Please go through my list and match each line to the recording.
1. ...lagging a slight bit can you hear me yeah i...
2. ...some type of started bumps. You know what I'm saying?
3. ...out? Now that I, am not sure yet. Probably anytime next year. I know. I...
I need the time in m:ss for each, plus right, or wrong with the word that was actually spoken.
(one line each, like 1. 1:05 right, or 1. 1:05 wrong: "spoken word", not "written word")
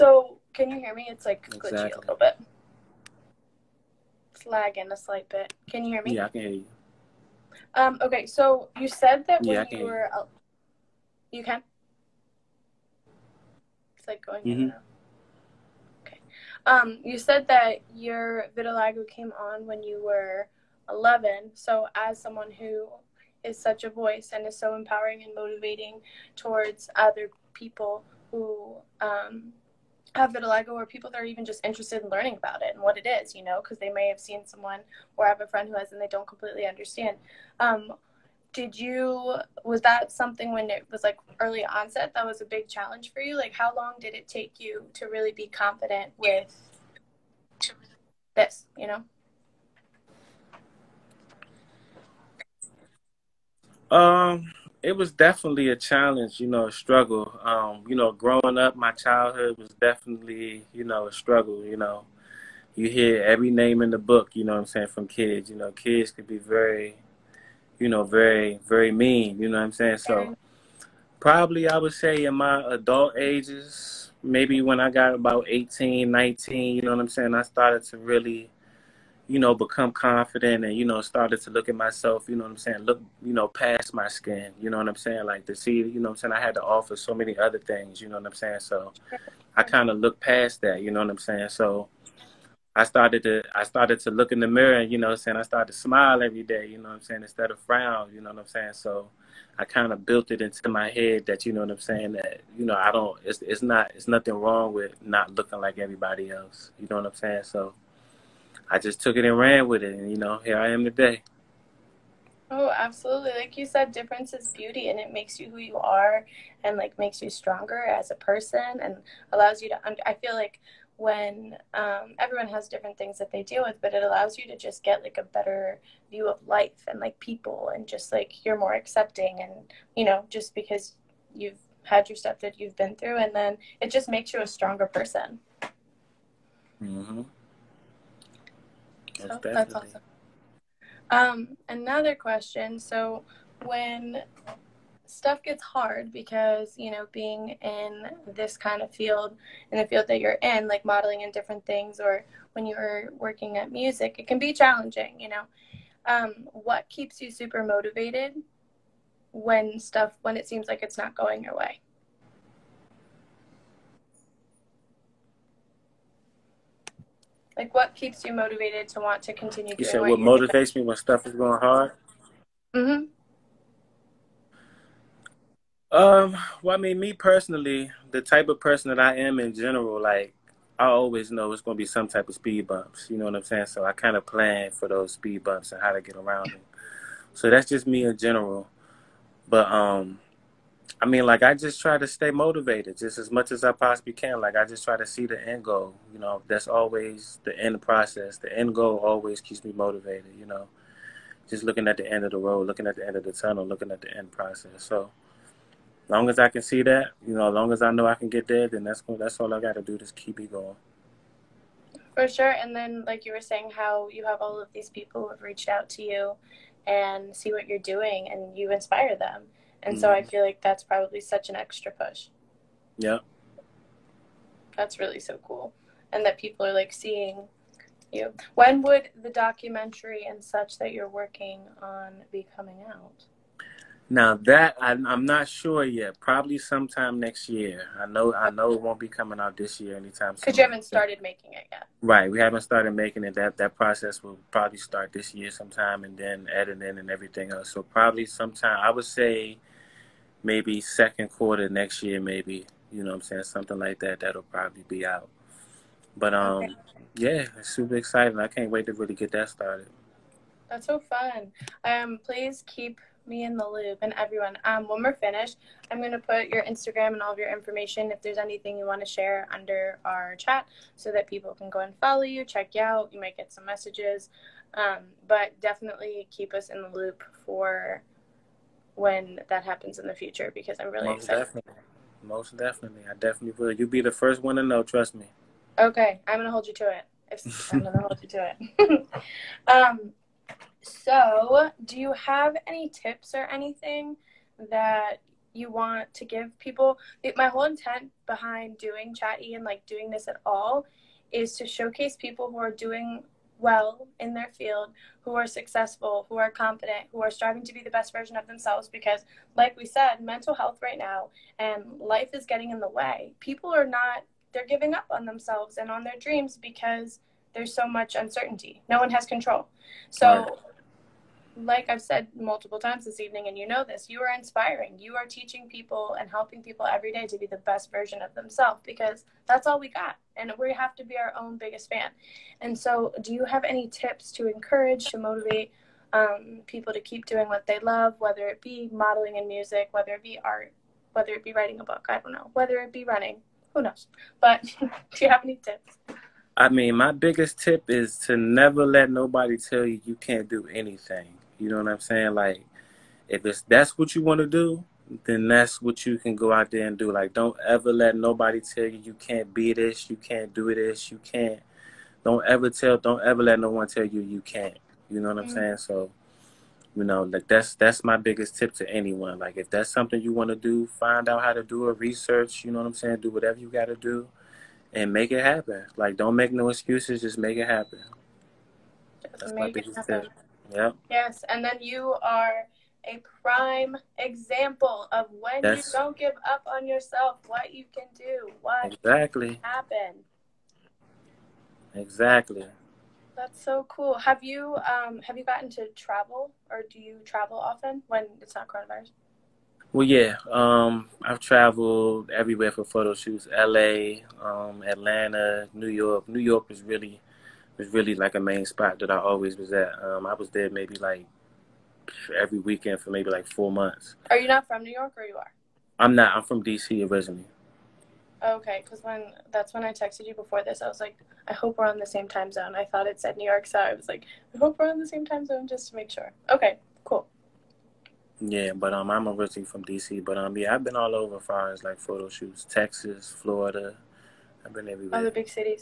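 1. 0:04 right
2. 3:01 wrong: "speed", not "started"
3. 3:52 wrong: "sometime", not "anytime".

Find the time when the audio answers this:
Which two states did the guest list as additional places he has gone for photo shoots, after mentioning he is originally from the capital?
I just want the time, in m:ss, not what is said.
7:12.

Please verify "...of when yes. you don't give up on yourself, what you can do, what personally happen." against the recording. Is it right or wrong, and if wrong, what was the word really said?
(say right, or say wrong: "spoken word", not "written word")
wrong: "exactly", not "personally".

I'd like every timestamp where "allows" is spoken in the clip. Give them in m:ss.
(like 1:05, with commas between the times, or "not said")
1:59, 2:04.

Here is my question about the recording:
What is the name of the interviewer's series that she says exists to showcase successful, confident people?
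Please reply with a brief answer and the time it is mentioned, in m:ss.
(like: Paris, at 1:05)
Chat E, at 4:59.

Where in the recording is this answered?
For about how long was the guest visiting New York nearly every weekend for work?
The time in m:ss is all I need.
6:53.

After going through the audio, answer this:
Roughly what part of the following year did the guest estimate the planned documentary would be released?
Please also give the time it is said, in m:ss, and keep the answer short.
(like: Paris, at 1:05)
second quarter, at 4:10.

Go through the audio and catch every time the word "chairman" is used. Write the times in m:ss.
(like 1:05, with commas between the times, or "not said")
not said.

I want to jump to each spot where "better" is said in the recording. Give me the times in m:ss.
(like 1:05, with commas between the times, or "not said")
2:05.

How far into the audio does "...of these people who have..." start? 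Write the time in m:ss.
3:34.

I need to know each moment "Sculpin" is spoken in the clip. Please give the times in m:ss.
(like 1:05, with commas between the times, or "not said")
not said.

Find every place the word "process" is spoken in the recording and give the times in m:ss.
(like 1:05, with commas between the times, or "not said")
3:17, 3:24, 4:03.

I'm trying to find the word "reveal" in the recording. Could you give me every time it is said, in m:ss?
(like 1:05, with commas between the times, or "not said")
not said.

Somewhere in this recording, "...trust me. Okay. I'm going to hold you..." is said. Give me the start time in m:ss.
4:44.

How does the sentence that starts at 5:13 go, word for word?
People are not, they're giving up on themselves and on their dreams because there's so much uncertainty.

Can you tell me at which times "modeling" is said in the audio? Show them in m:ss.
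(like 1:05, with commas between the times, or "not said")
2:30, 5:38.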